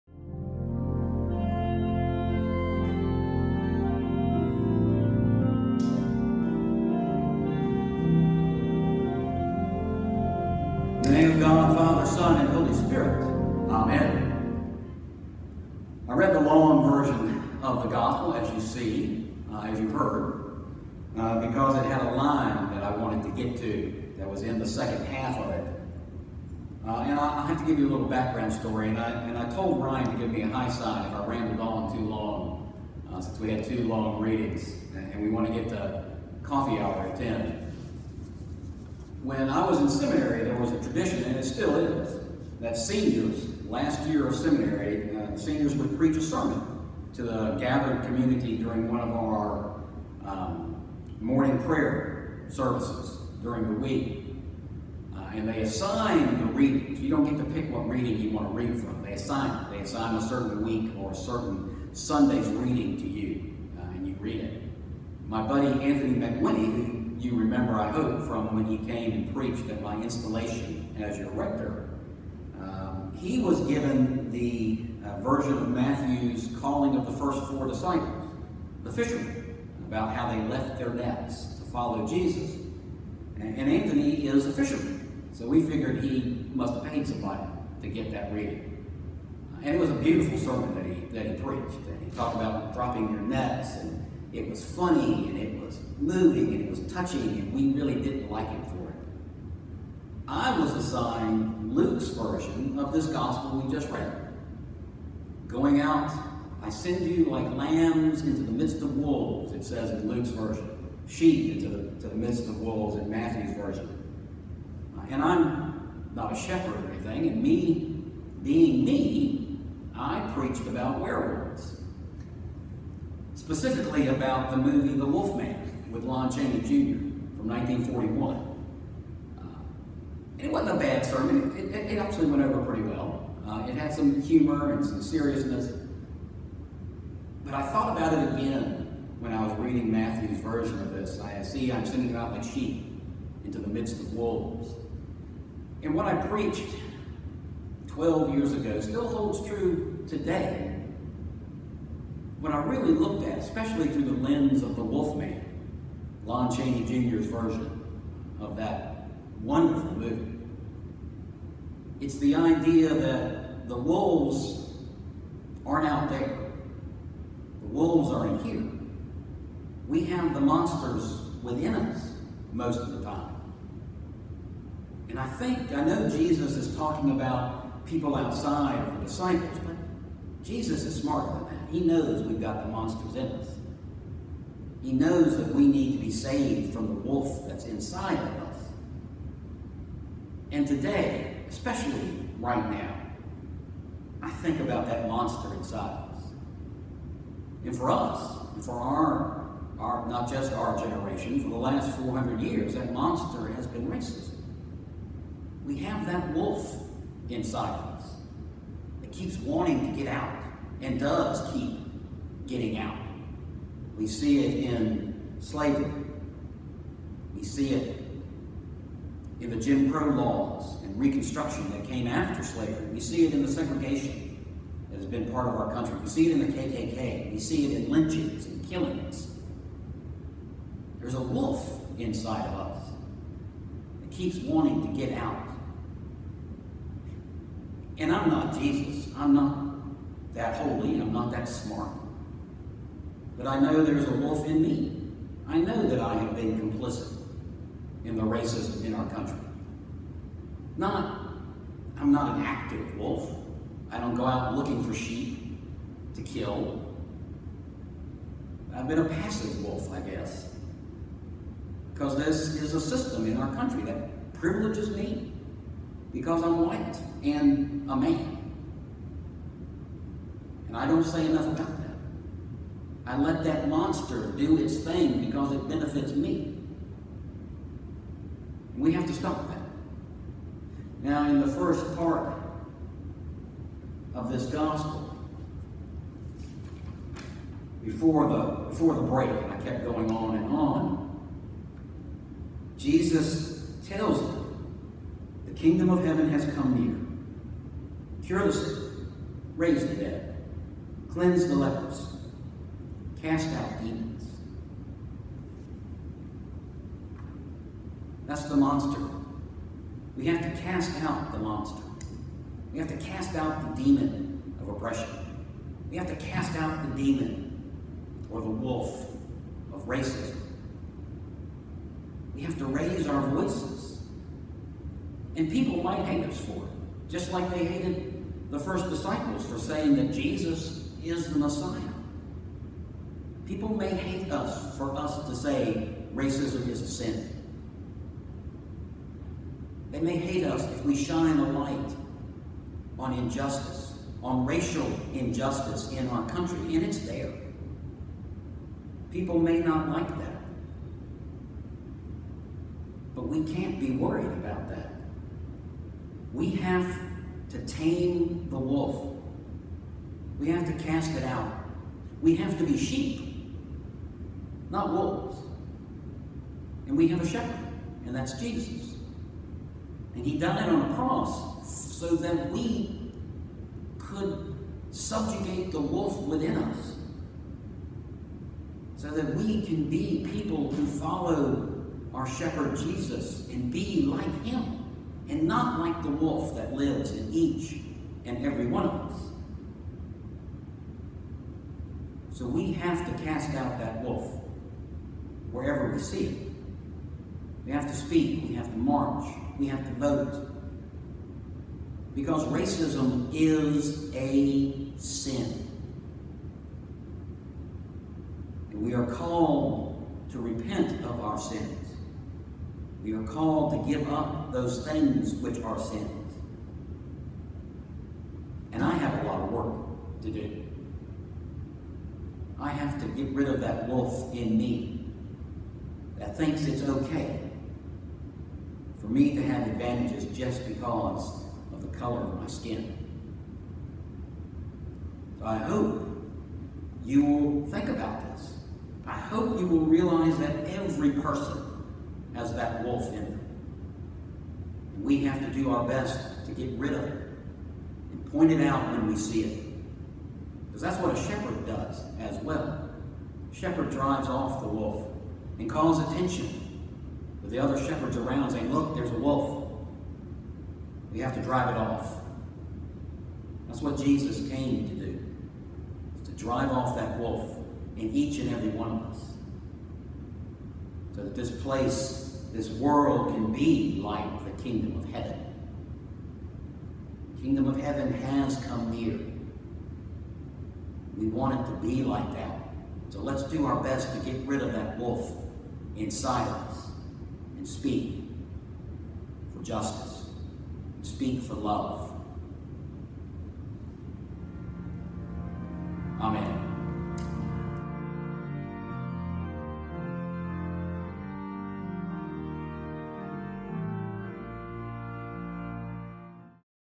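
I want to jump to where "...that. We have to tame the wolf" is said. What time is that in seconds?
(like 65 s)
354 s.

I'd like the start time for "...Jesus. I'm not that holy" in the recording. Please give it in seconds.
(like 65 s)
238 s.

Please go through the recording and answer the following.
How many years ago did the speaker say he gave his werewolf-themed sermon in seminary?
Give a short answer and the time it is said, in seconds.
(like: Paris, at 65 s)
12, at 147 s.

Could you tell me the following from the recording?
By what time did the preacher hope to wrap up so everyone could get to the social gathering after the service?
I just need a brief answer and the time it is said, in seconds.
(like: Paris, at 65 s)
10, at 37 s.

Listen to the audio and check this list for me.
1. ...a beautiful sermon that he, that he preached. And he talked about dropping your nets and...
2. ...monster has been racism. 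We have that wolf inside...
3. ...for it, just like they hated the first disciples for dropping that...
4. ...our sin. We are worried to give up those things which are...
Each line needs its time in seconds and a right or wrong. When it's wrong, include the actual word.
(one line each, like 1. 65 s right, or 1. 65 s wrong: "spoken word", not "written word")
1. 89 s right
2. 202 s right
3. 326 s wrong: "saying", not "dropping"
4. 411 s wrong: "called", not "worried".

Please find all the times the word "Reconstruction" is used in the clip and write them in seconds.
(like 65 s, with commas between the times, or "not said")
220 s.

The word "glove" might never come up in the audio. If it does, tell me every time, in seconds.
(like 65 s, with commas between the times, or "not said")
not said.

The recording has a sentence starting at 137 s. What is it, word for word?
But I thought about it again when I was reading Matthew's version of this.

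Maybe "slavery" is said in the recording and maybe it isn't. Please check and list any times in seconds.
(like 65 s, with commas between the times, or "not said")
215 s, 222 s.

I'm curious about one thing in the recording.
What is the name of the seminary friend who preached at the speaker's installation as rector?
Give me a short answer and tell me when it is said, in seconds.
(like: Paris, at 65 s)
Anthony McWinney, at 65 s.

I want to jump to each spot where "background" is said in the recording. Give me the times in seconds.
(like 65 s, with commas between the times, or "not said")
28 s.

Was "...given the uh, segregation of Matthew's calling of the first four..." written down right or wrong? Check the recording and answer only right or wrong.
wrong.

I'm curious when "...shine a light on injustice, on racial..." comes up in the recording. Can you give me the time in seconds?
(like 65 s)
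340 s.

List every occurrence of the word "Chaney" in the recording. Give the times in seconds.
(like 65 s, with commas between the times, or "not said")
126 s, 156 s.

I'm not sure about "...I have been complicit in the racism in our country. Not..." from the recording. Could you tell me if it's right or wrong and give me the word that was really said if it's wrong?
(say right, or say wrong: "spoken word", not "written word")
right.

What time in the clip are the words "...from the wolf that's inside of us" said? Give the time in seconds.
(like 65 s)
186 s.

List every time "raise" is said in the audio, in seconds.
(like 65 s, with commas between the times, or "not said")
299 s, 322 s.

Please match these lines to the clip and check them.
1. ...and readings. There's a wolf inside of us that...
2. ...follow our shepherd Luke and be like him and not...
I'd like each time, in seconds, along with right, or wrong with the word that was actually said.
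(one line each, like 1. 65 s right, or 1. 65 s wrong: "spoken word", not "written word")
1. 228 s wrong: "killings", not "readings"
2. 380 s wrong: "Jesus", not "Luke".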